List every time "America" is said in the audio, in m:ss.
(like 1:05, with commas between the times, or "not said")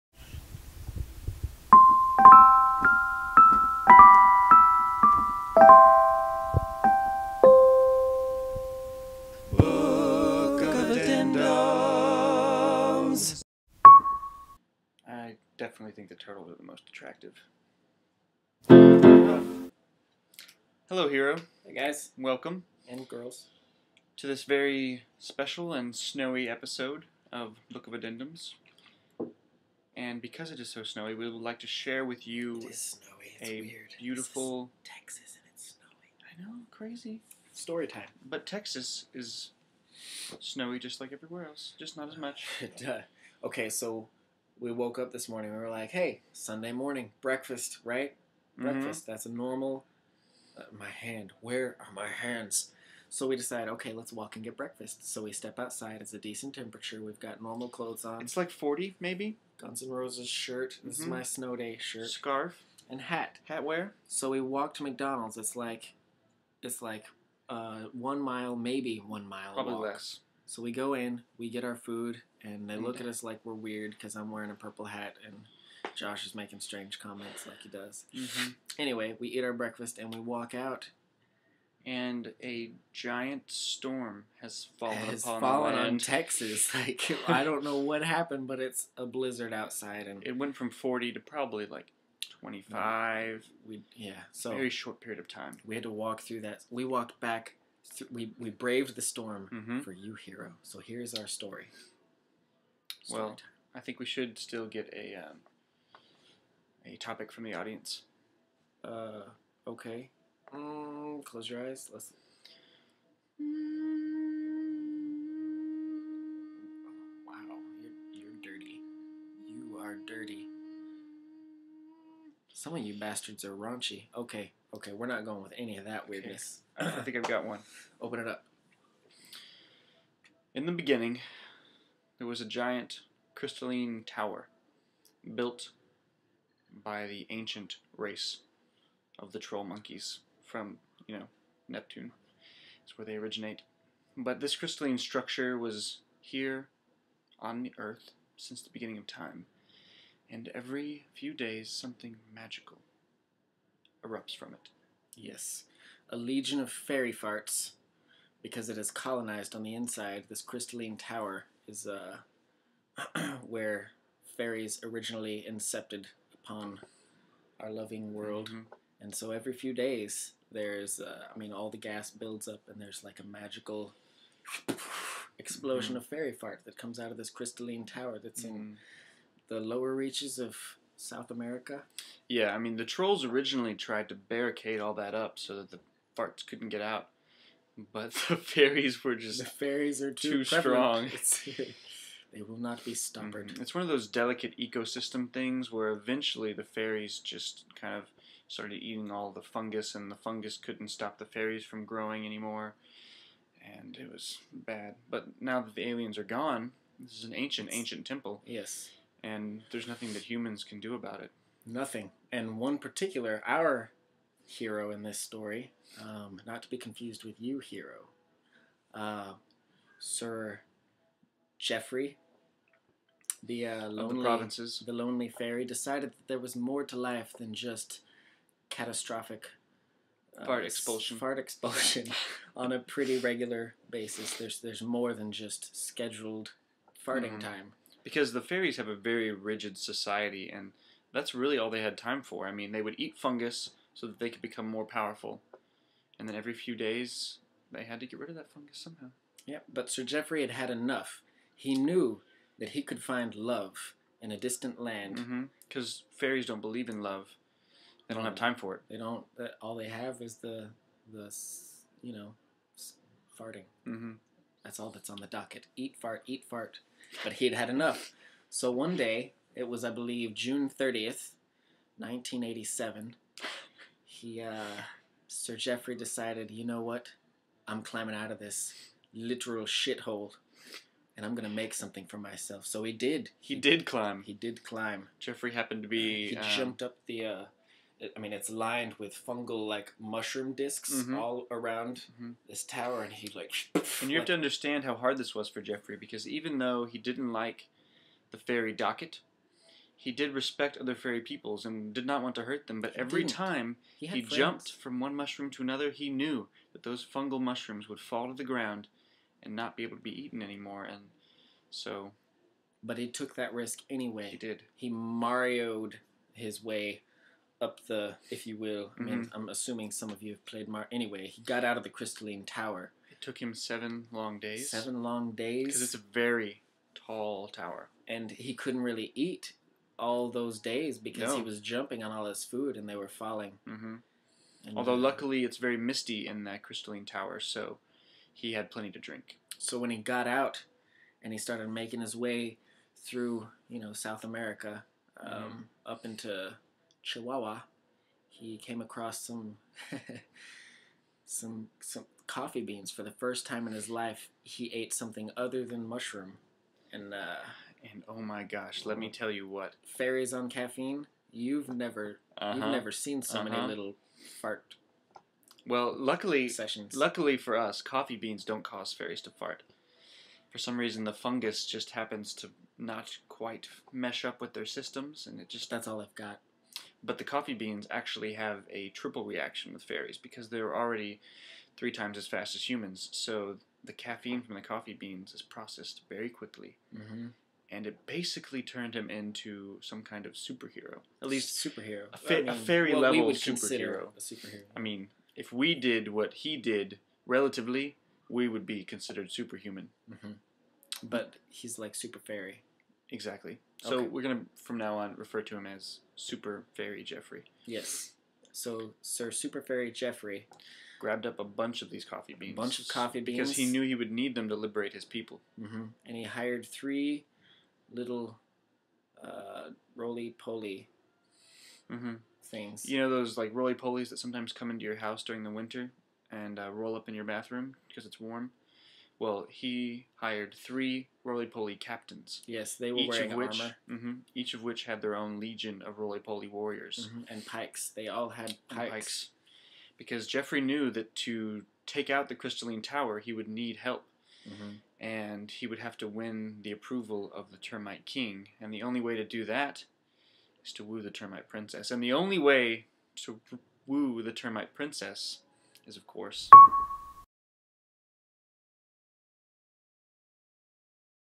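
3:01, 5:44.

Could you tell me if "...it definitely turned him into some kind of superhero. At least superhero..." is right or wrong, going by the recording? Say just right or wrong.
wrong.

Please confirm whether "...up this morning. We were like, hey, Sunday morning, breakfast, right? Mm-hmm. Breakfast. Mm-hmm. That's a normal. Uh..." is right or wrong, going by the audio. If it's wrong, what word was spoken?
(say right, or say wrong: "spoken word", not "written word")
right.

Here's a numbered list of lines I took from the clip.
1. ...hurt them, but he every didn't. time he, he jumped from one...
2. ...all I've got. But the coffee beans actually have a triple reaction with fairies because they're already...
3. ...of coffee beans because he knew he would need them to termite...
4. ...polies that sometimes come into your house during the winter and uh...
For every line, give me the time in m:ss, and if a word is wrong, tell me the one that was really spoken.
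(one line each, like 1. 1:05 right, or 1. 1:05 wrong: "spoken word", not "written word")
1. 5:02 right
2. 6:15 right
3. 6:52 wrong: "liberate", not "termite"
4. 7:03 right.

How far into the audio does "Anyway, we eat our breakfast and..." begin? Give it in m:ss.
1:18.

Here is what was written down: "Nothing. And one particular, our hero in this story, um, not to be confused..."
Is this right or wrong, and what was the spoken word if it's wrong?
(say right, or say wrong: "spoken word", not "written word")
right.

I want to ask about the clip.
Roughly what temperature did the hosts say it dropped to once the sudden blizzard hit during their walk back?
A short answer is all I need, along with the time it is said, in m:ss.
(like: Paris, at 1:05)
25, at 1:32.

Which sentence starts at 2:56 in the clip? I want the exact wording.
of fairy fart that comes out of this crystalline tower that's mm -hmm.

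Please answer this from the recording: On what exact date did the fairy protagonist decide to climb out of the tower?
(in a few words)
June 30, 1987.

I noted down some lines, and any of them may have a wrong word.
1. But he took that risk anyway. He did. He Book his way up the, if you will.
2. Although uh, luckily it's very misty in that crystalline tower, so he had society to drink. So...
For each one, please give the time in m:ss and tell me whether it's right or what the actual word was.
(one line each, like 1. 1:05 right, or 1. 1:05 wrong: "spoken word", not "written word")
1. 5:12 wrong: "Marioed", not "Book"
2. 5:34 wrong: "plenty", not "society".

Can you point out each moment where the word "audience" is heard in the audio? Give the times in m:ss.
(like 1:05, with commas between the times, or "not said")
1:47.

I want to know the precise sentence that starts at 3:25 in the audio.
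But now that the aliens are gone, this is an ancient, ancient temple.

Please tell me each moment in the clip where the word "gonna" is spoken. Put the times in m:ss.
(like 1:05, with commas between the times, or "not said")
4:41, 6:44.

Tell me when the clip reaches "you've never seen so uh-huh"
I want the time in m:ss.
6:02.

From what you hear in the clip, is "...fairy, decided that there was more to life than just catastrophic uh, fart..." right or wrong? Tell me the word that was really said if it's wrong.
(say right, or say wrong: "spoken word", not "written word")
right.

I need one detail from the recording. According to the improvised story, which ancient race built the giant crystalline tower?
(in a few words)
troll monkeys.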